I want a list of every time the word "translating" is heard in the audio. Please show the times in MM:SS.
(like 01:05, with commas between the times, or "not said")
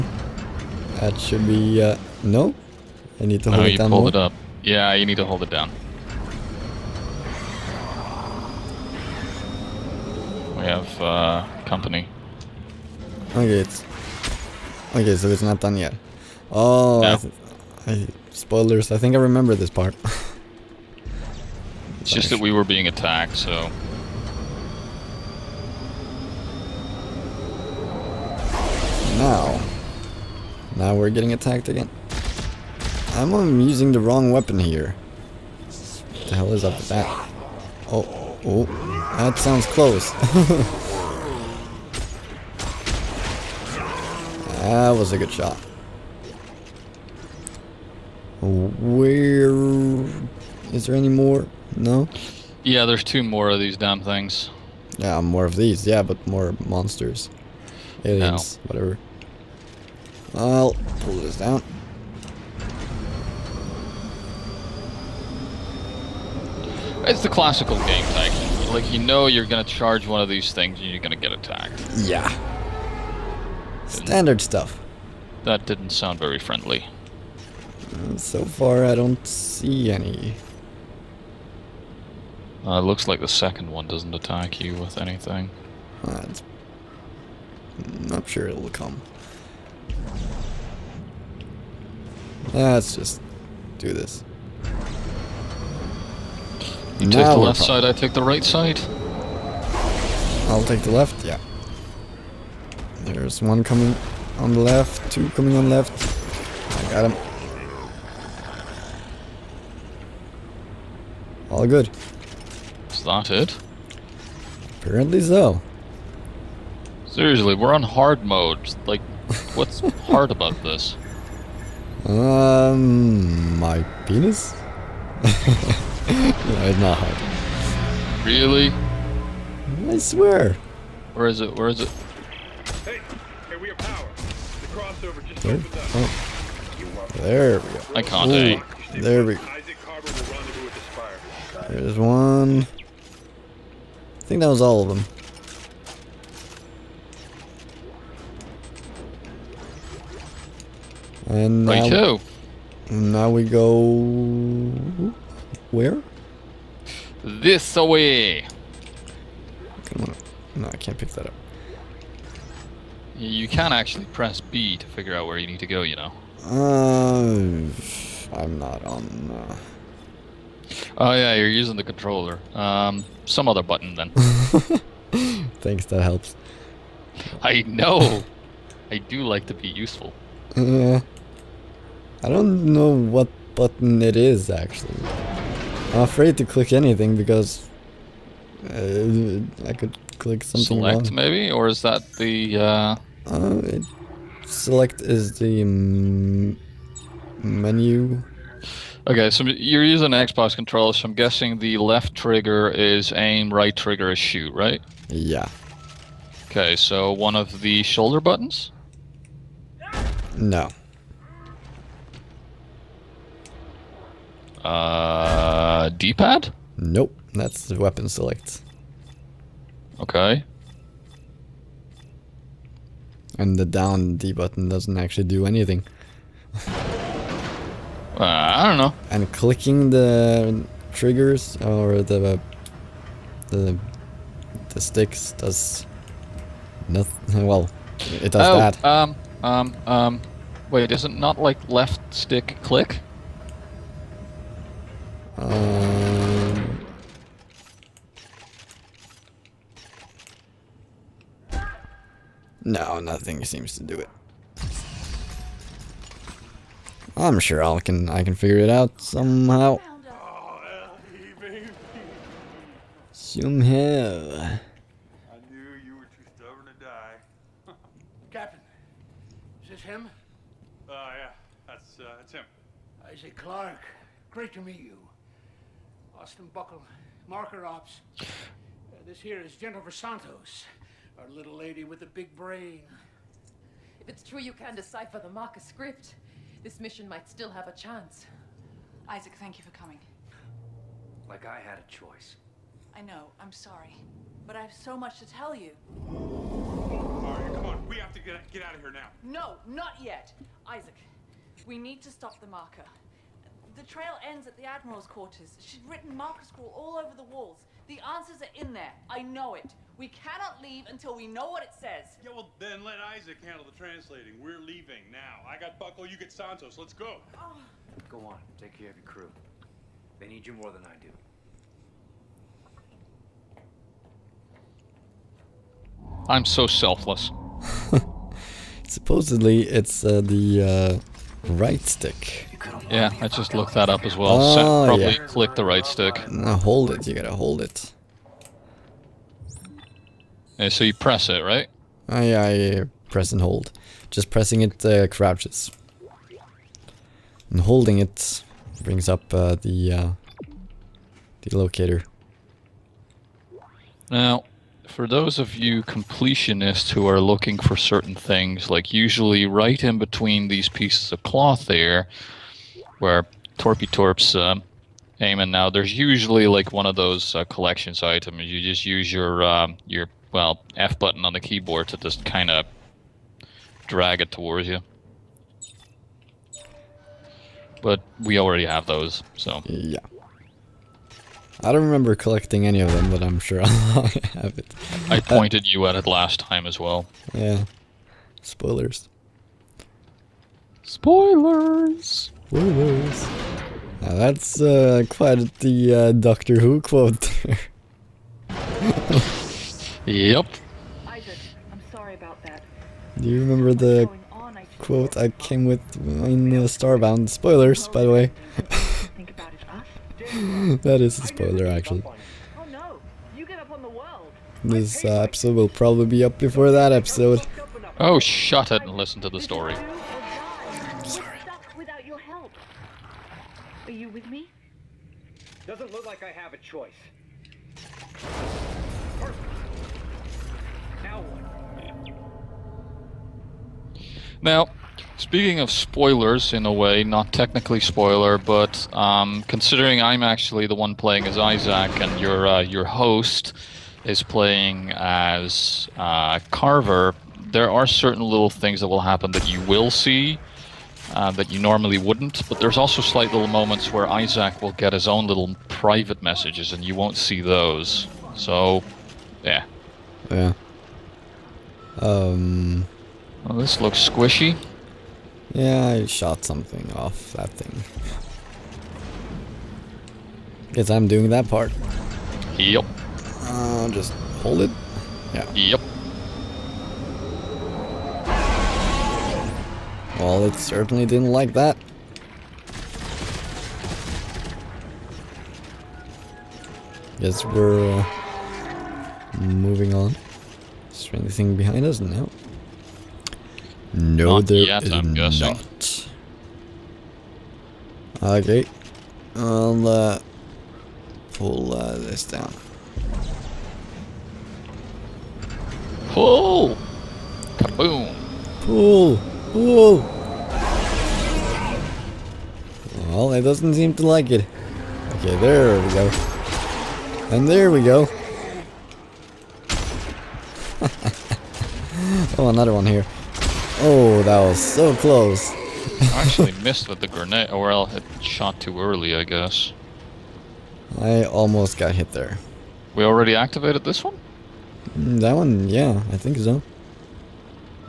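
05:13.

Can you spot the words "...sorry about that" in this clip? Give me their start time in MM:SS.
06:41.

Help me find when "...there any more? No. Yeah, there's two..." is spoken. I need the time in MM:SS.
00:50.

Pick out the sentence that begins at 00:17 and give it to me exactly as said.
I, spoilers, I think I remember this part.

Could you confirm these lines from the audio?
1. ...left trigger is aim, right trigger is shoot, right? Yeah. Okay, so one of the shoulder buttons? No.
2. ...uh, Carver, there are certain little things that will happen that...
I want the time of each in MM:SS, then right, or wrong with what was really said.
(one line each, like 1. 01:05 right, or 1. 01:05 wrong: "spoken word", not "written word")
1. 03:21 right
2. 07:25 right.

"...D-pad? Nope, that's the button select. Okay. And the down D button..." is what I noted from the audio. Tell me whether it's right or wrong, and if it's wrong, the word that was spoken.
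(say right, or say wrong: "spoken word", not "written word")
wrong: "weapon", not "button".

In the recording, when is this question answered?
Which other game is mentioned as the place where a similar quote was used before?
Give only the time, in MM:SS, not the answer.
06:46.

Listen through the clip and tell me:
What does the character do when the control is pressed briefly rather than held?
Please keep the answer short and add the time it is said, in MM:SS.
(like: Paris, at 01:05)
Crouches, at 05:45.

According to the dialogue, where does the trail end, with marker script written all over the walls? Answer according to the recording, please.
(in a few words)
The Admiral's quarters.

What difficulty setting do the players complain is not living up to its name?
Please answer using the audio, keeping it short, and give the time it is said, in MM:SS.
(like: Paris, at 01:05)
Hard mode, at 01:57.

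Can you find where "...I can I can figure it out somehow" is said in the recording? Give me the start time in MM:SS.
04:17.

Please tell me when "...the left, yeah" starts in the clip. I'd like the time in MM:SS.
01:40.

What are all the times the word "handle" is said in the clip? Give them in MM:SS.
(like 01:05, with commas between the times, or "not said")
05:13.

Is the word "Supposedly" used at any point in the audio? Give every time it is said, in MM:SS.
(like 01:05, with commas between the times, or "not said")
05:28.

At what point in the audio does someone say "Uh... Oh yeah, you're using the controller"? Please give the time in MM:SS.
02:49.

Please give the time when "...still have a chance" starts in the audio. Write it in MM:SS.
04:47.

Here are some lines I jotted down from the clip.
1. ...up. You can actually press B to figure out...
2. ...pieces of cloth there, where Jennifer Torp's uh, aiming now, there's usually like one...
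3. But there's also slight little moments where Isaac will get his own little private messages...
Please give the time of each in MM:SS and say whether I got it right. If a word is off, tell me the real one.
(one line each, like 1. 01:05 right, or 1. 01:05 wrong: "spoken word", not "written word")
1. 02:41 right
2. 06:00 wrong: "Torpy", not "Jennifer"
3. 07:32 right.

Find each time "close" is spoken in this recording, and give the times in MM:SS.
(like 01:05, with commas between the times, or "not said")
00:39, 08:44.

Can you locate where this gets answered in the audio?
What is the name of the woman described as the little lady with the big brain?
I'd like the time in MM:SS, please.
04:39.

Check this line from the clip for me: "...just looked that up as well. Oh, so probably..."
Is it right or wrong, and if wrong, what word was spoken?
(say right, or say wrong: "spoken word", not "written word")
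right.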